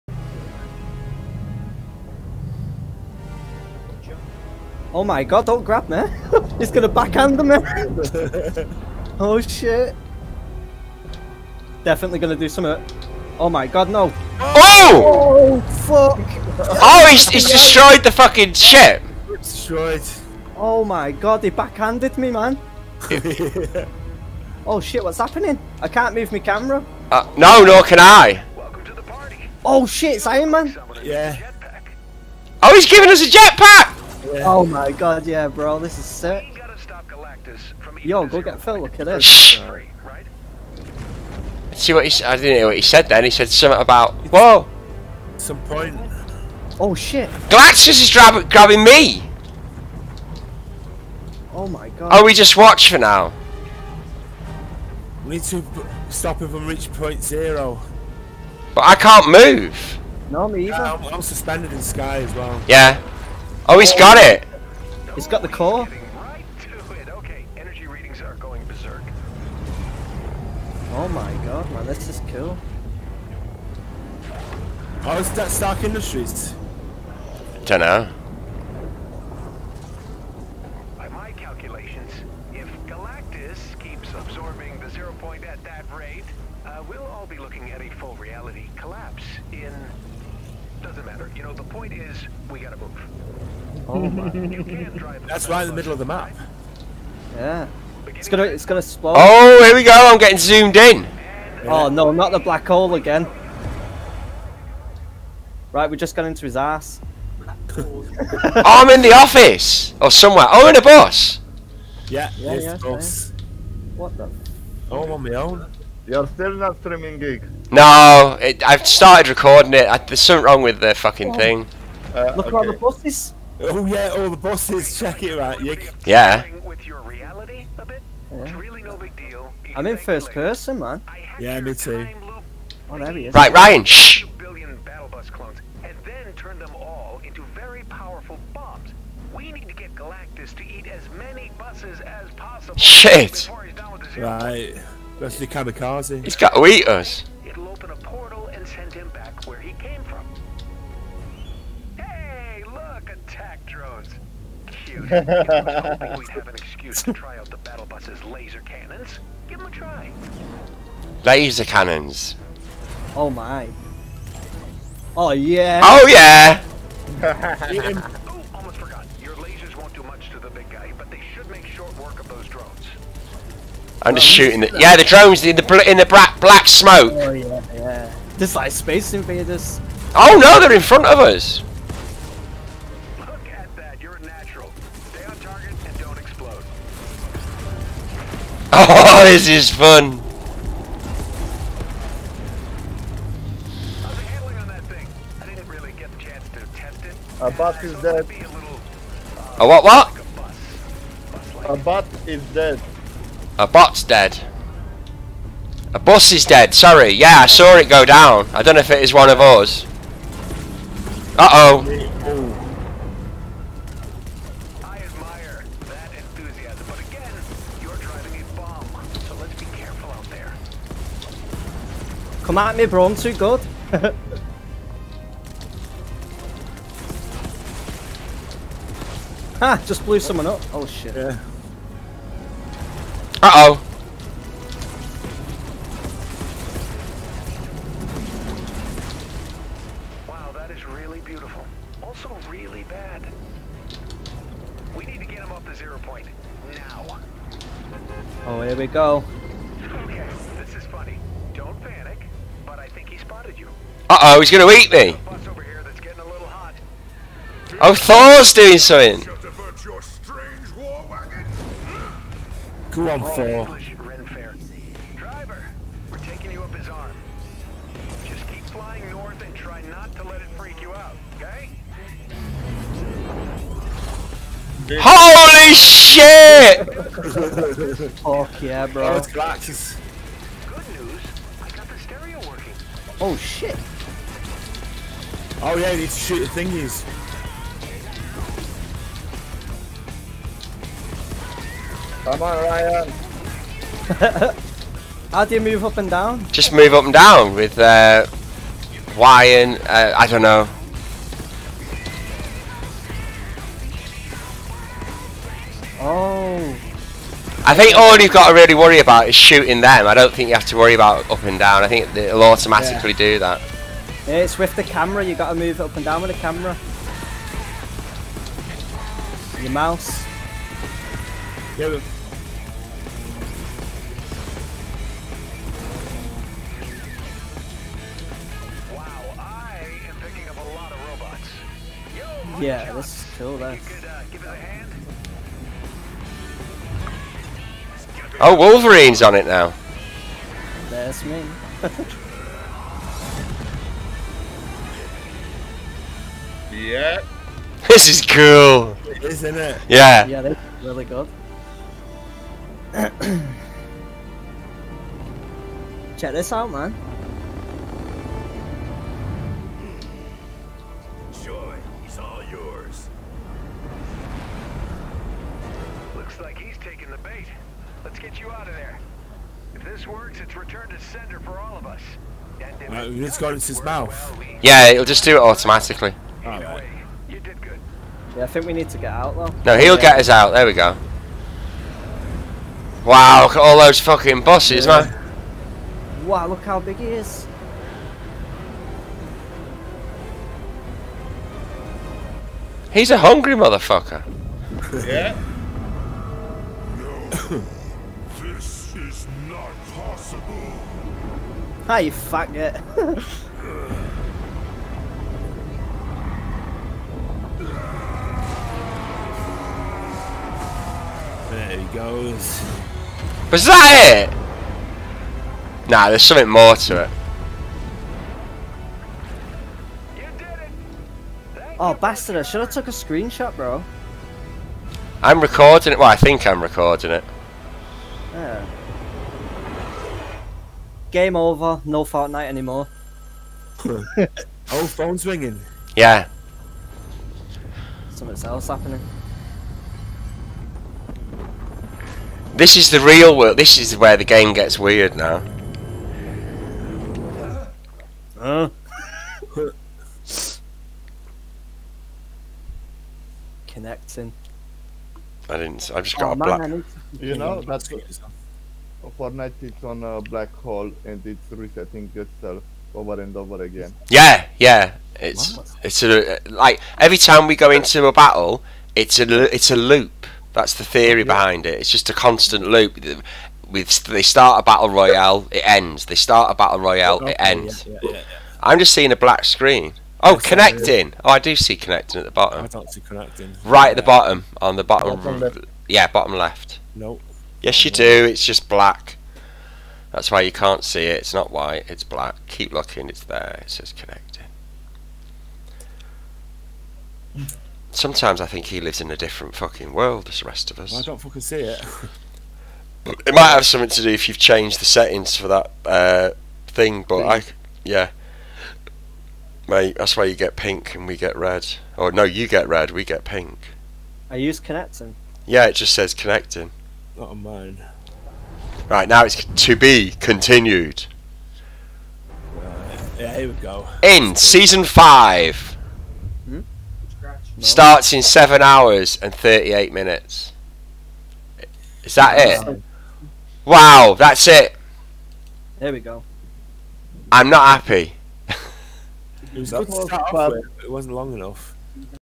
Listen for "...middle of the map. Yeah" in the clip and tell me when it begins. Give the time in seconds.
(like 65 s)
95 s.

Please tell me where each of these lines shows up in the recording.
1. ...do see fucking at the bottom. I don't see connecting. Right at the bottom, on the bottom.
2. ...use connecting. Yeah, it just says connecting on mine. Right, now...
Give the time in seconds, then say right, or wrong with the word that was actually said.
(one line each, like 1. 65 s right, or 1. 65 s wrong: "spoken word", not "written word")
1. 481 s wrong: "connecting", not "fucking"
2. 514 s right.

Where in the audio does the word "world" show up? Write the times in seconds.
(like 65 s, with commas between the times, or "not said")
443 s, 499 s.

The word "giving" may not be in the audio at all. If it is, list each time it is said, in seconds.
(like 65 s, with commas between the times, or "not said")
32 s.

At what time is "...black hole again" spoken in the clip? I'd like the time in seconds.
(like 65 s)
102 s.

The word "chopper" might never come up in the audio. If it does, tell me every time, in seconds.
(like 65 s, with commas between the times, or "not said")
not said.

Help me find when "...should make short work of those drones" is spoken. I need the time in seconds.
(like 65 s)
171 s.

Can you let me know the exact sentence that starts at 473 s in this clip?
With they start a battle royale, it ends.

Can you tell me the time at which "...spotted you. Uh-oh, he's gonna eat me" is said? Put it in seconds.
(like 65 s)
253 s.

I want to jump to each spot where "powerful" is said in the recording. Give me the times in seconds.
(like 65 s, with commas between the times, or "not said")
137 s.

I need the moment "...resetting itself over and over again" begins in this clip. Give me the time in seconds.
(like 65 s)
461 s.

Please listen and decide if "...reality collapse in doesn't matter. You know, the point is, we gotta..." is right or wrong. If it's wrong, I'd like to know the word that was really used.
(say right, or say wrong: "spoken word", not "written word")
right.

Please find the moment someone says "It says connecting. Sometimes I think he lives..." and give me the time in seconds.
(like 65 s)
493 s.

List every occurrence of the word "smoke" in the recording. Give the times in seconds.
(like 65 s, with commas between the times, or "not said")
176 s.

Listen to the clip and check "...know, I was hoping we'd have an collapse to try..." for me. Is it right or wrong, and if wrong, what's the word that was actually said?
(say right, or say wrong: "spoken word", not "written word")
wrong: "excuse", not "collapse".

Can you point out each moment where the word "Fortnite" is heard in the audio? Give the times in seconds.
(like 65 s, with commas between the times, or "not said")
432 s, 459 s.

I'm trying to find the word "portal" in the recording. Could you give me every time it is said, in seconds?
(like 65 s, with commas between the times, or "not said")
147 s.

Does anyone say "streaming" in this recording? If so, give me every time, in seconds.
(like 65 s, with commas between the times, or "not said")
116 s.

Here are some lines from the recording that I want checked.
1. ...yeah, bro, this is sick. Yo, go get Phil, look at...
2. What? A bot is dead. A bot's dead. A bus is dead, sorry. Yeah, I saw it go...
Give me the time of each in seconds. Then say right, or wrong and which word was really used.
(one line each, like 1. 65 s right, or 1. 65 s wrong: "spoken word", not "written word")
1. 35 s right
2. 199 s right.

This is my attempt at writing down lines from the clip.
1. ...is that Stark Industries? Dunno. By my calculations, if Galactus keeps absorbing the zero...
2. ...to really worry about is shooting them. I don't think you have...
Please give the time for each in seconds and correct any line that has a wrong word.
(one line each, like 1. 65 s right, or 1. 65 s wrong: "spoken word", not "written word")
1. 75 s right
2. 308 s right.